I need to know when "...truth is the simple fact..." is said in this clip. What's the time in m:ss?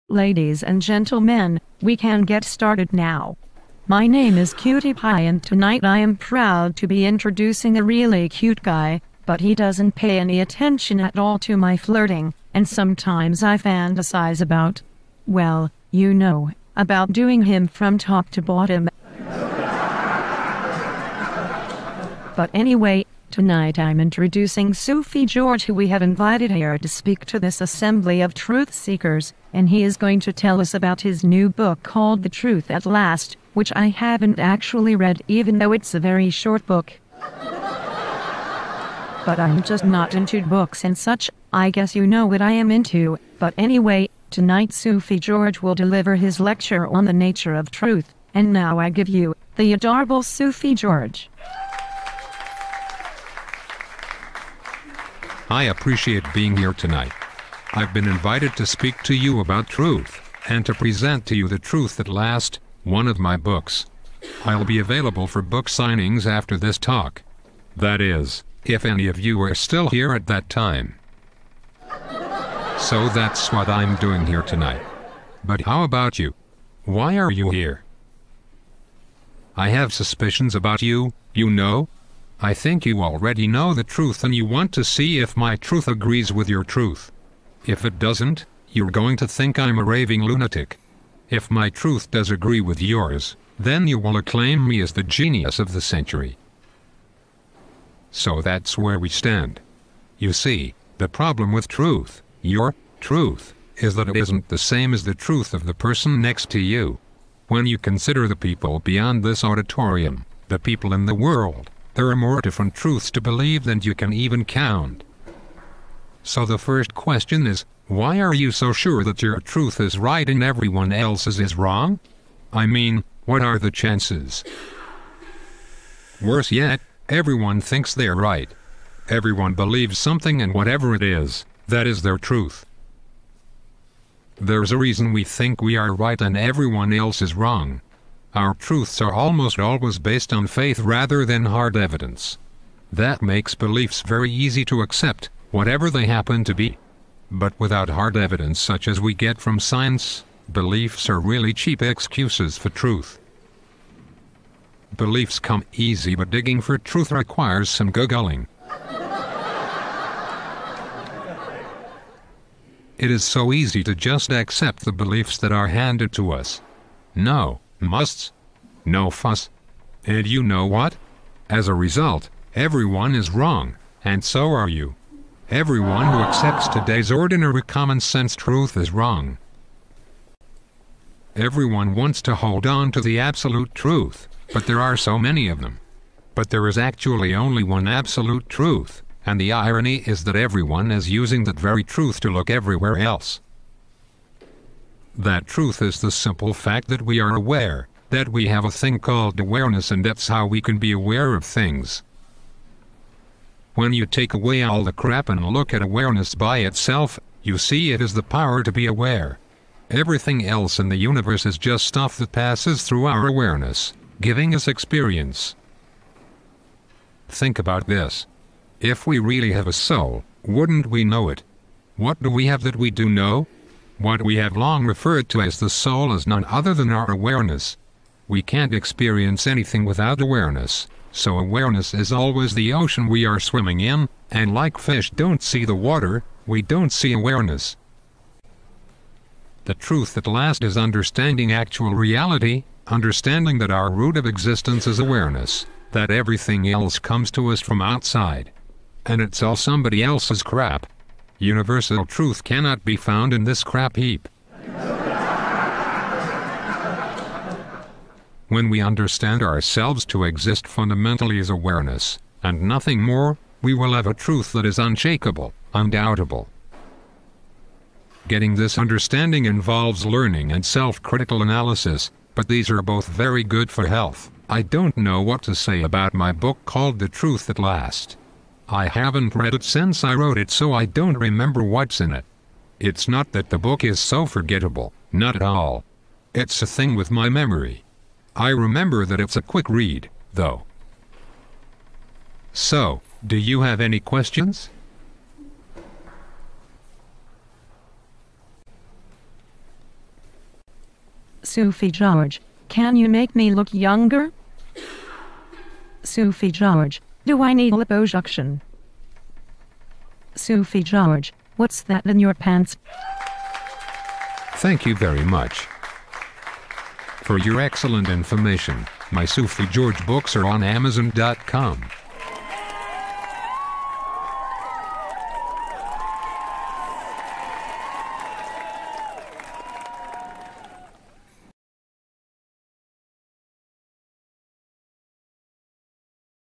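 3:15.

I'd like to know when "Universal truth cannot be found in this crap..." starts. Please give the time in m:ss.
4:11.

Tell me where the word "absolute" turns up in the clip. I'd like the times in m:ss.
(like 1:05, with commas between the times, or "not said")
3:03, 3:07.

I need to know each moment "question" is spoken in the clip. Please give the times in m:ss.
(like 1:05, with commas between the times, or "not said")
1:56, 4:53.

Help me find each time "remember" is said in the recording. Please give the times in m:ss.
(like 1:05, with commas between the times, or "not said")
4:41, 4:48.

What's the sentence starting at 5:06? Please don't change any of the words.
Sufi George, do I need liposuction?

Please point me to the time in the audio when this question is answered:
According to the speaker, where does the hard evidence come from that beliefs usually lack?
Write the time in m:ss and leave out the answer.
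2:29.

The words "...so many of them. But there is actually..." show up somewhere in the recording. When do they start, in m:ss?
3:04.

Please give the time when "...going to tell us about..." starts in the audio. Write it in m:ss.
0:29.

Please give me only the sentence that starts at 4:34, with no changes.
I don't know what to say about my book called The Truth at Last.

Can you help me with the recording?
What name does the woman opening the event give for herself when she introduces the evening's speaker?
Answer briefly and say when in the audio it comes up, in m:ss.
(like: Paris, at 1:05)
Cutie Pie, at 0:04.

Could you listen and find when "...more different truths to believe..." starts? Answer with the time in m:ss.
1:52.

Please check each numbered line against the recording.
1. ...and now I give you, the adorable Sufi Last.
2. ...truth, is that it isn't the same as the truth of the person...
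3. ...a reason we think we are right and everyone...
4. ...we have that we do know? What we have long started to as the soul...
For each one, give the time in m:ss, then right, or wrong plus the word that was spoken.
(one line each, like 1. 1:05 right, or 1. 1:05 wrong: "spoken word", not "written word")
1. 0:48 wrong: "George", not "Last"
2. 1:42 right
3. 2:14 right
4. 3:42 wrong: "referred", not "started".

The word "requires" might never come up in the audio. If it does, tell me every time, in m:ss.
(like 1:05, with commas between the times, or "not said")
2:37.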